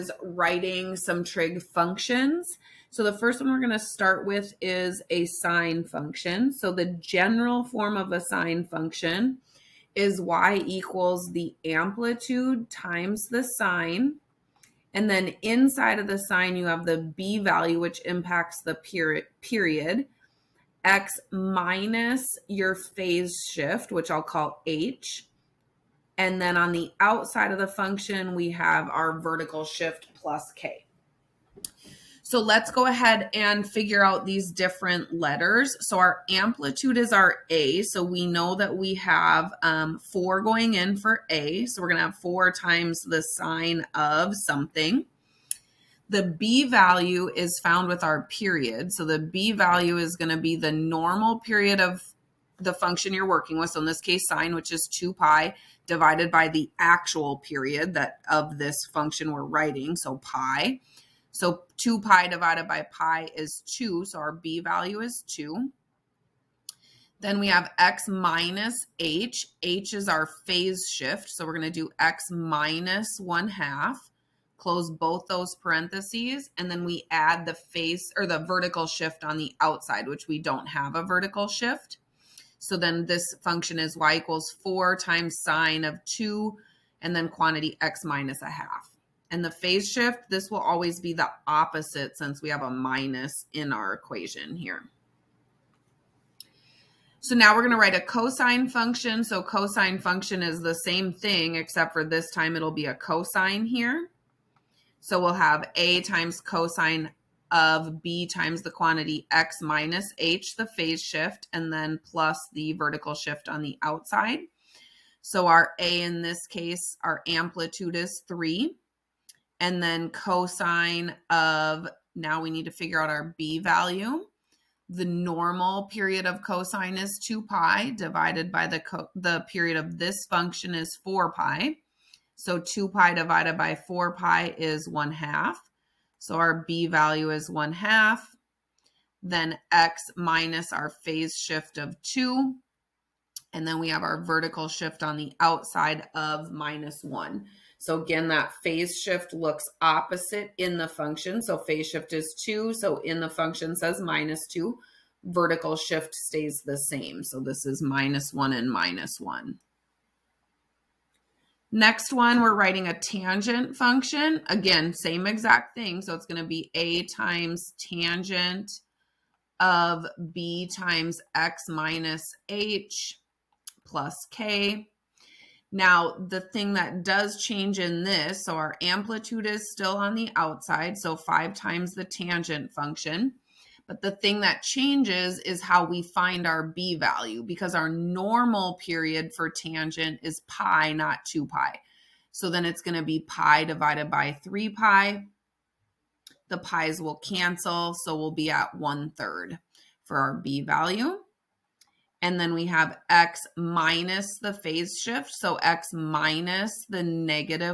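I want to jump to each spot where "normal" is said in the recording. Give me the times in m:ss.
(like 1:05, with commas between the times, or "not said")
0:50, 2:05, 3:07.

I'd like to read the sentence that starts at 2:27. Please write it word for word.
So again, that phase shift looks opposite in the function.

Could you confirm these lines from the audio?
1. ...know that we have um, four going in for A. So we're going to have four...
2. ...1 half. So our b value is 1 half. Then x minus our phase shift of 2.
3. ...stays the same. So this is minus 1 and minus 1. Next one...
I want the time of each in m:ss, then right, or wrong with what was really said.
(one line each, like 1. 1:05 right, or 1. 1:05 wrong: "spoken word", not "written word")
1. 0:38 right
2. 2:14 right
3. 2:36 right.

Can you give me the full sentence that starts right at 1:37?
So now we're going to write a cosine function.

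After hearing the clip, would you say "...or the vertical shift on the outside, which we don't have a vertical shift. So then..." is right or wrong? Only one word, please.
right.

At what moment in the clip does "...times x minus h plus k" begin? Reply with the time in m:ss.
2:50.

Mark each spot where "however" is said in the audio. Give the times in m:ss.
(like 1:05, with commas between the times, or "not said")
not said.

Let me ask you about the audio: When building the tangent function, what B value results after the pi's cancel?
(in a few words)
1/3.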